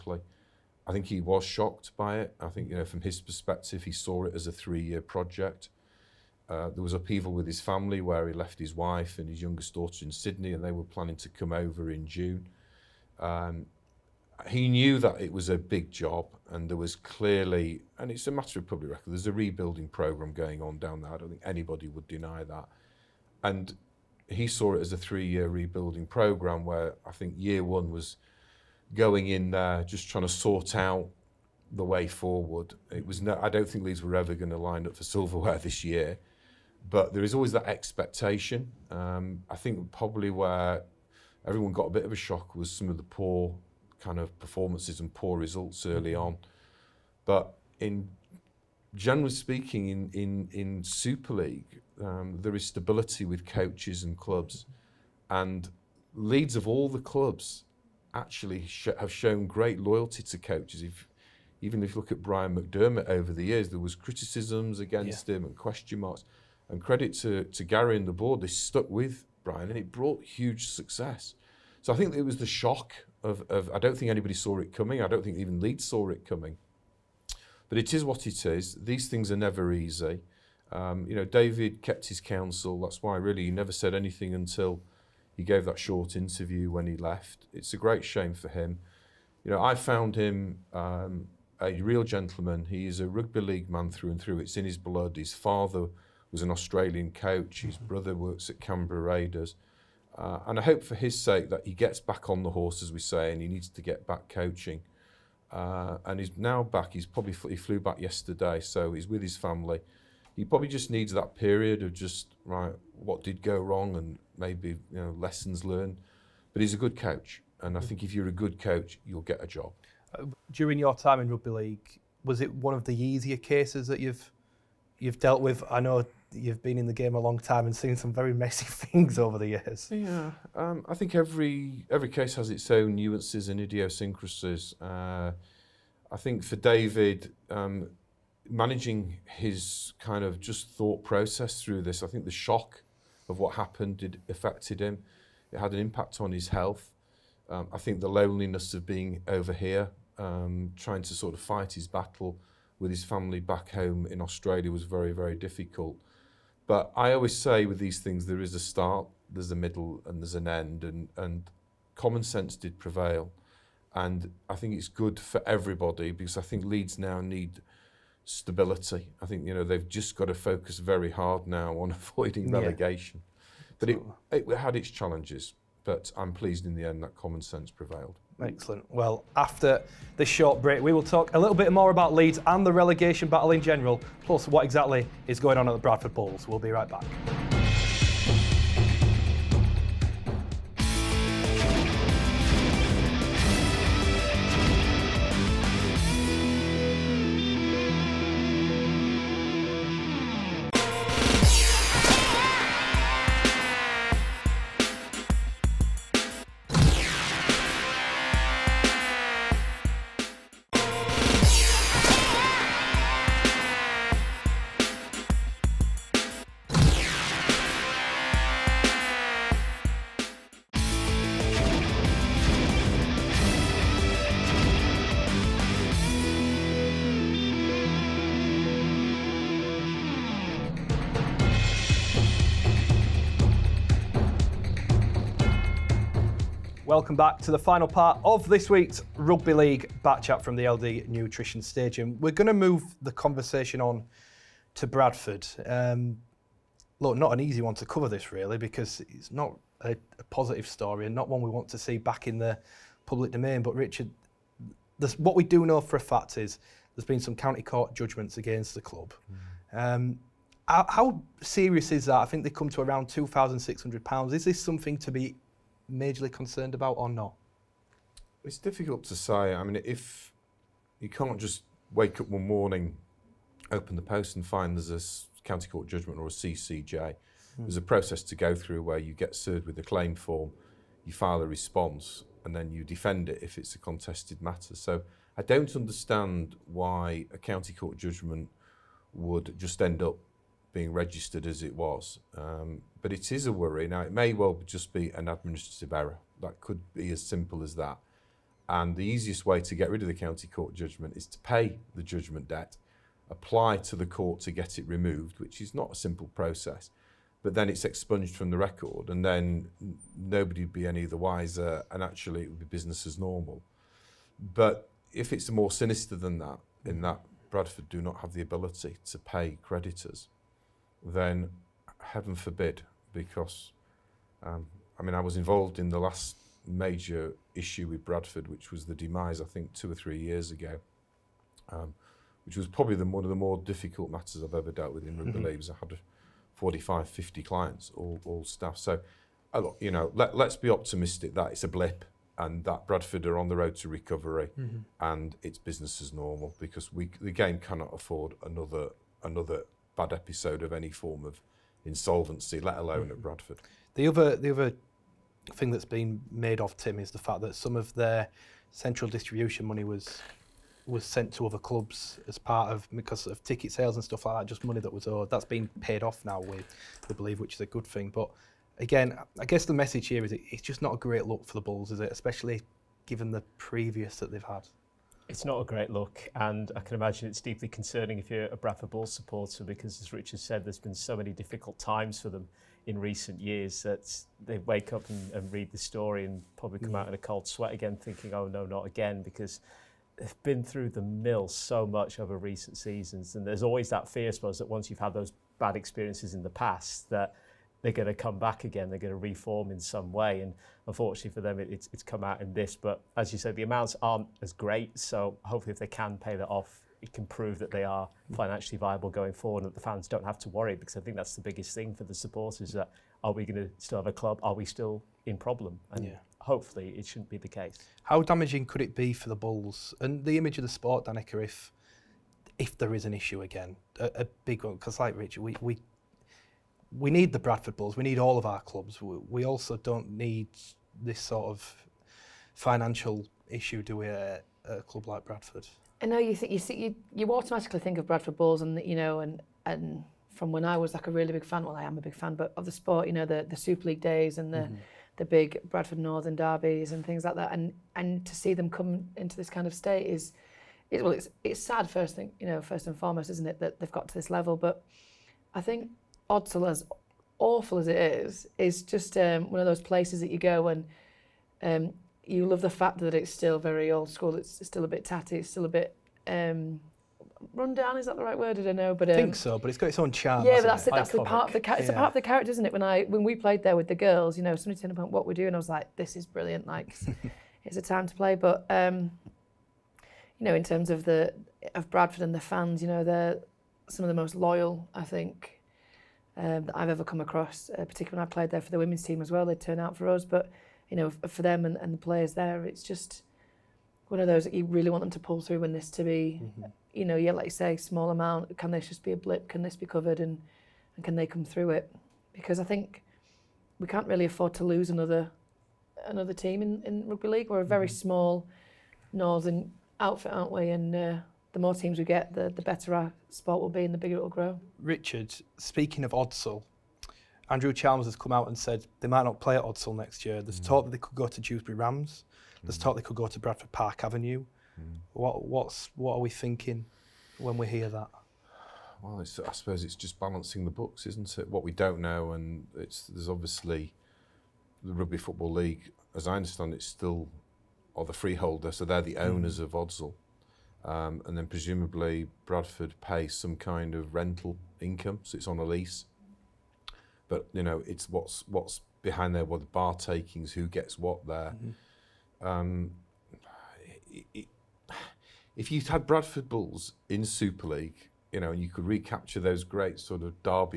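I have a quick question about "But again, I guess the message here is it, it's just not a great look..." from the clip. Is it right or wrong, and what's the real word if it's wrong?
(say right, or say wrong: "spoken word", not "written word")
right.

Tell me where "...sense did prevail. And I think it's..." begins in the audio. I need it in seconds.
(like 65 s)
162 s.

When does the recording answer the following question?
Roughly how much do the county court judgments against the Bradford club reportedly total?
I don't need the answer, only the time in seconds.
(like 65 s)
263 s.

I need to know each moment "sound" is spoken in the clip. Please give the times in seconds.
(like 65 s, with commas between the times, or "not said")
not said.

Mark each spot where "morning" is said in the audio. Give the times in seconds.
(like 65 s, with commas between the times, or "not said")
272 s.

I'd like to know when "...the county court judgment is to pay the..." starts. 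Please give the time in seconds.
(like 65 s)
300 s.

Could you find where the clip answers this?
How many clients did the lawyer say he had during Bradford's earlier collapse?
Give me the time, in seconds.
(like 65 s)
336 s.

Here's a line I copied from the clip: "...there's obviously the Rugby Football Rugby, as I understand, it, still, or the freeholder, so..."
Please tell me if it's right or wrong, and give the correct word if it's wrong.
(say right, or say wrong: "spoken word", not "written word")
wrong: "League", not "Rugby".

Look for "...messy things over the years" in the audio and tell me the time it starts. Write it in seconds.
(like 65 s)
128 s.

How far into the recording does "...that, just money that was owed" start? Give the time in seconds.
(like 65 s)
364 s.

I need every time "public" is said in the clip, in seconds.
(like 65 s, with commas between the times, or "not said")
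18 s, 253 s.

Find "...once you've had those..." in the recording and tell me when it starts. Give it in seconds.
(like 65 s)
394 s.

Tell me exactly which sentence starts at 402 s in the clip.
But as you said, the amounts aren't as great.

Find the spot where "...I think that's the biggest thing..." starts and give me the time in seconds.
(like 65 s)
410 s.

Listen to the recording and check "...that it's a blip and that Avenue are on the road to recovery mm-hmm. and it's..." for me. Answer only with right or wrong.
wrong.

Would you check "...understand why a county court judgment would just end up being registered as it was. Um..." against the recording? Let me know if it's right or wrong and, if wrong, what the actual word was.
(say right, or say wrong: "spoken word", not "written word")
right.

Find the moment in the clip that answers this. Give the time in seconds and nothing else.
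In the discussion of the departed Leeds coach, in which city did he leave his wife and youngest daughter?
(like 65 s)
10 s.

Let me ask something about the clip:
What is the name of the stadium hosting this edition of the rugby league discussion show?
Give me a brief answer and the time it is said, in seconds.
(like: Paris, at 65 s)
LD Nutrition Stadium, at 240 s.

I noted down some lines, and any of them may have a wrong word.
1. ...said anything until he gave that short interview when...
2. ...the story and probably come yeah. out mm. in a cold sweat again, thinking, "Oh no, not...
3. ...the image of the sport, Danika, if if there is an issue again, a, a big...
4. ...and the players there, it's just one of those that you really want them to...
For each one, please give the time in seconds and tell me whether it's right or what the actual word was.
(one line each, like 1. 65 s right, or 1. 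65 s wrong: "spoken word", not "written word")
1. 83 s right
2. 385 s right
3. 420 s right
4. 491 s right.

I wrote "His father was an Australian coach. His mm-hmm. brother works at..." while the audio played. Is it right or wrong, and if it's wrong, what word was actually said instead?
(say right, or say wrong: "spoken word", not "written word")
right.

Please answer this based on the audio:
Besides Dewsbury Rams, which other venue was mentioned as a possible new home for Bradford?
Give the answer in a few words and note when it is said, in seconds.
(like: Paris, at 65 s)
Bradford Park Avenue, at 523 s.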